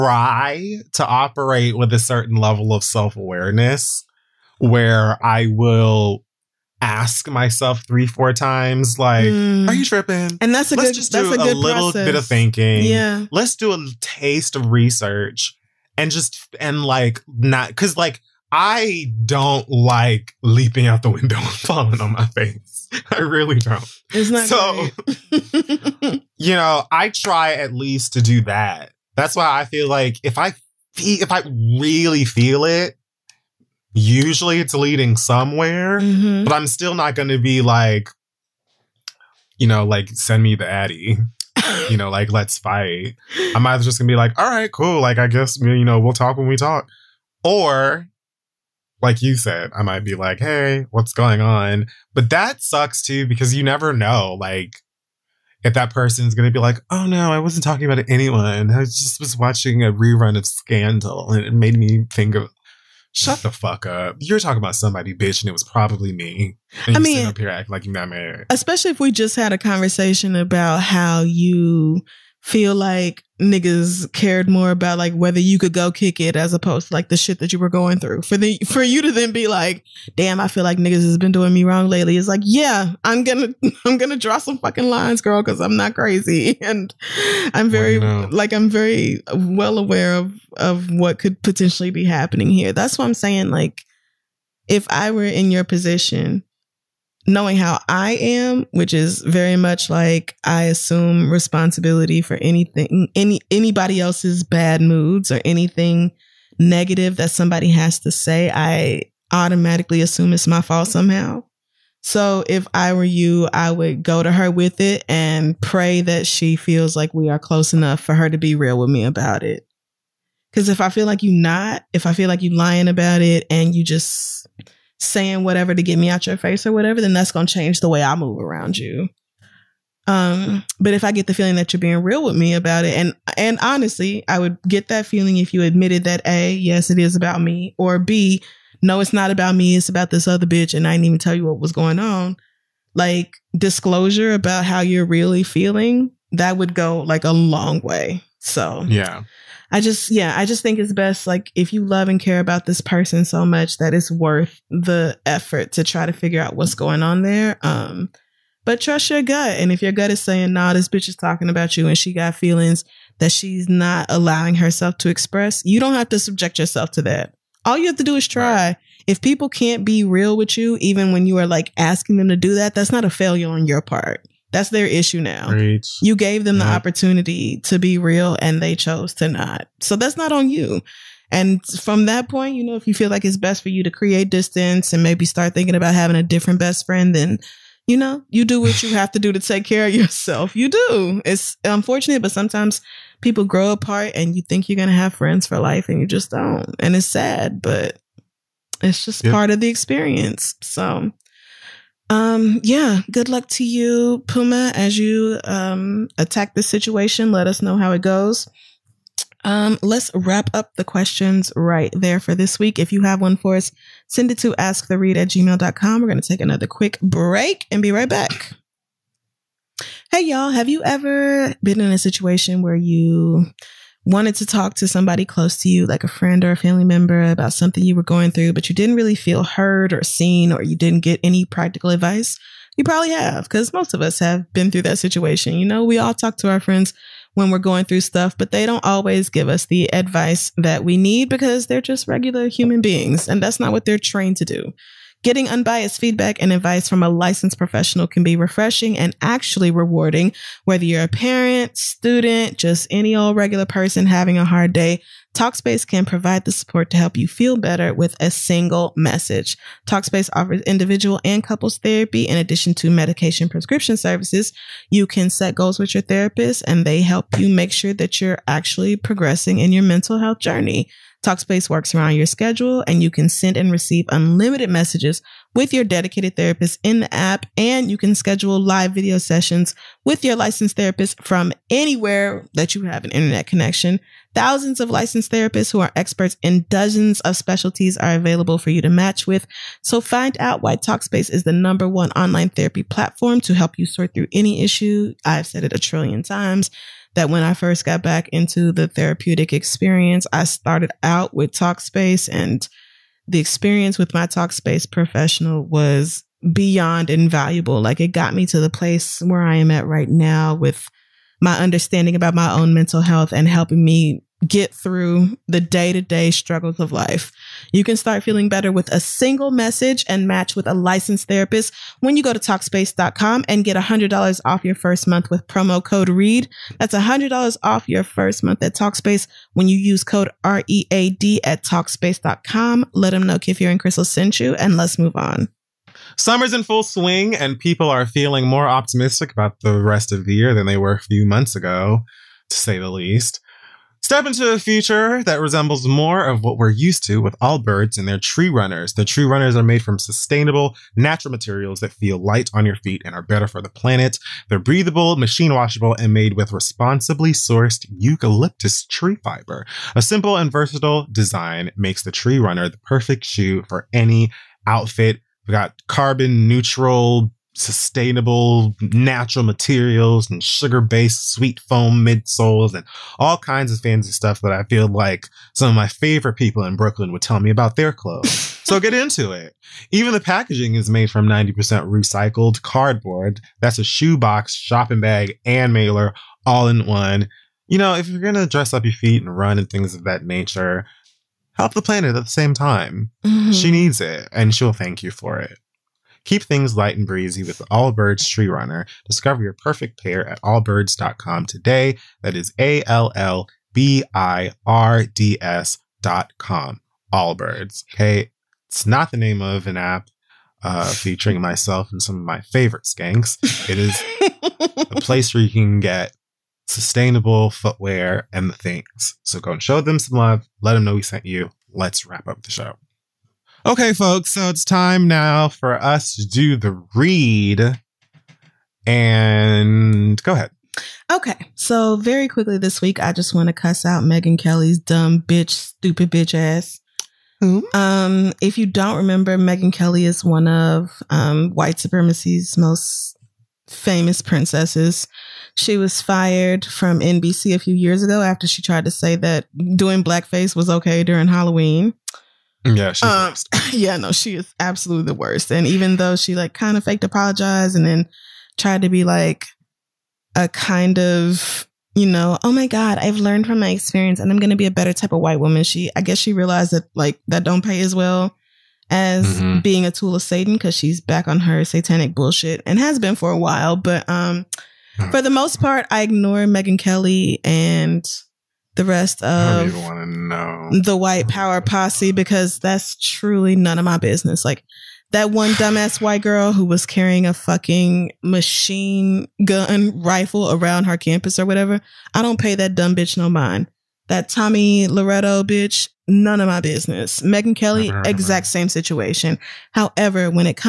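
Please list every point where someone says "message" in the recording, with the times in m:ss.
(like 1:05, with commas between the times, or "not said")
4:18, 4:34, 5:19.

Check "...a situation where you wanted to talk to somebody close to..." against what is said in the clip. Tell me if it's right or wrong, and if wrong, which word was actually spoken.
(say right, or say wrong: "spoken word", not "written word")
right.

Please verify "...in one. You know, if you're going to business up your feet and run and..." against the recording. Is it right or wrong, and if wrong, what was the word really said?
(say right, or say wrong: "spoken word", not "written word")
wrong: "dress", not "business".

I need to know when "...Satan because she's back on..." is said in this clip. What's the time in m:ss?
7:50.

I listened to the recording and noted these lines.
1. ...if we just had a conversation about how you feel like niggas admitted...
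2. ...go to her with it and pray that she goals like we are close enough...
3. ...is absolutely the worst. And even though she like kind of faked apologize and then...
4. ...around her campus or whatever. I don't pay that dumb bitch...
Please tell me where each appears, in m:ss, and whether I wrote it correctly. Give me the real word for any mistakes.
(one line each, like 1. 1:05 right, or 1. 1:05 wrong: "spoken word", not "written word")
1. 1:08 wrong: "cared", not "admitted"
2. 1:54 wrong: "feels", not "goals"
3. 7:34 right
4. 8:10 right.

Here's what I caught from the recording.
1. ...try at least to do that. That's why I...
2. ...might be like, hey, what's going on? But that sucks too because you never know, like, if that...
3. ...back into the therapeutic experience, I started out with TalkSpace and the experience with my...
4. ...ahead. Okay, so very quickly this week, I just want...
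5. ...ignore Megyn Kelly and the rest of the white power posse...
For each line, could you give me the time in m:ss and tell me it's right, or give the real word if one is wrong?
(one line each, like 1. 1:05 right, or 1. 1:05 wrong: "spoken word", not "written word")
1. 0:27 right
2. 0:49 right
3. 4:58 right
4. 7:10 right
5. 7:56 right.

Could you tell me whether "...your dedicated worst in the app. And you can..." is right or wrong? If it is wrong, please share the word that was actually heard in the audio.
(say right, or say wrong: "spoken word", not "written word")
wrong: "therapist", not "worst".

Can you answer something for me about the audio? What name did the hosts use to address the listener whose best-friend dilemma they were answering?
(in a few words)
Puma.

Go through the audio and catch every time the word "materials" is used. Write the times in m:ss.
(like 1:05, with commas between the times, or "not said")
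5:51, 6:09.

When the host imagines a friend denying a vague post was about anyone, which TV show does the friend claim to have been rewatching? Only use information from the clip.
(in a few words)
Scandal.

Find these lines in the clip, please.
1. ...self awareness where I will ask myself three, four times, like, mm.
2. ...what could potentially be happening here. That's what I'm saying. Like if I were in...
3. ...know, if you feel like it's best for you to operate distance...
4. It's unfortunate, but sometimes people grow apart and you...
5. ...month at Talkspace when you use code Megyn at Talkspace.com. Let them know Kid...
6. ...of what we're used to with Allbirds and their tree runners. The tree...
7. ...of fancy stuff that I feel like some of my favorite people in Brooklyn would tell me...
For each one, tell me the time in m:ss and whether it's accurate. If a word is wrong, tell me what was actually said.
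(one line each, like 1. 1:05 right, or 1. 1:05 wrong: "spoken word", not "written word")
1. 0:02 right
2. 1:30 right
3. 3:02 wrong: "create", not "operate"
4. 3:11 right
5. 5:28 wrong: "READ", not "Megyn"
6. 5:46 right
7. 6:13 right.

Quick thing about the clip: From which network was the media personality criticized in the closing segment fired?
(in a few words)
NBC.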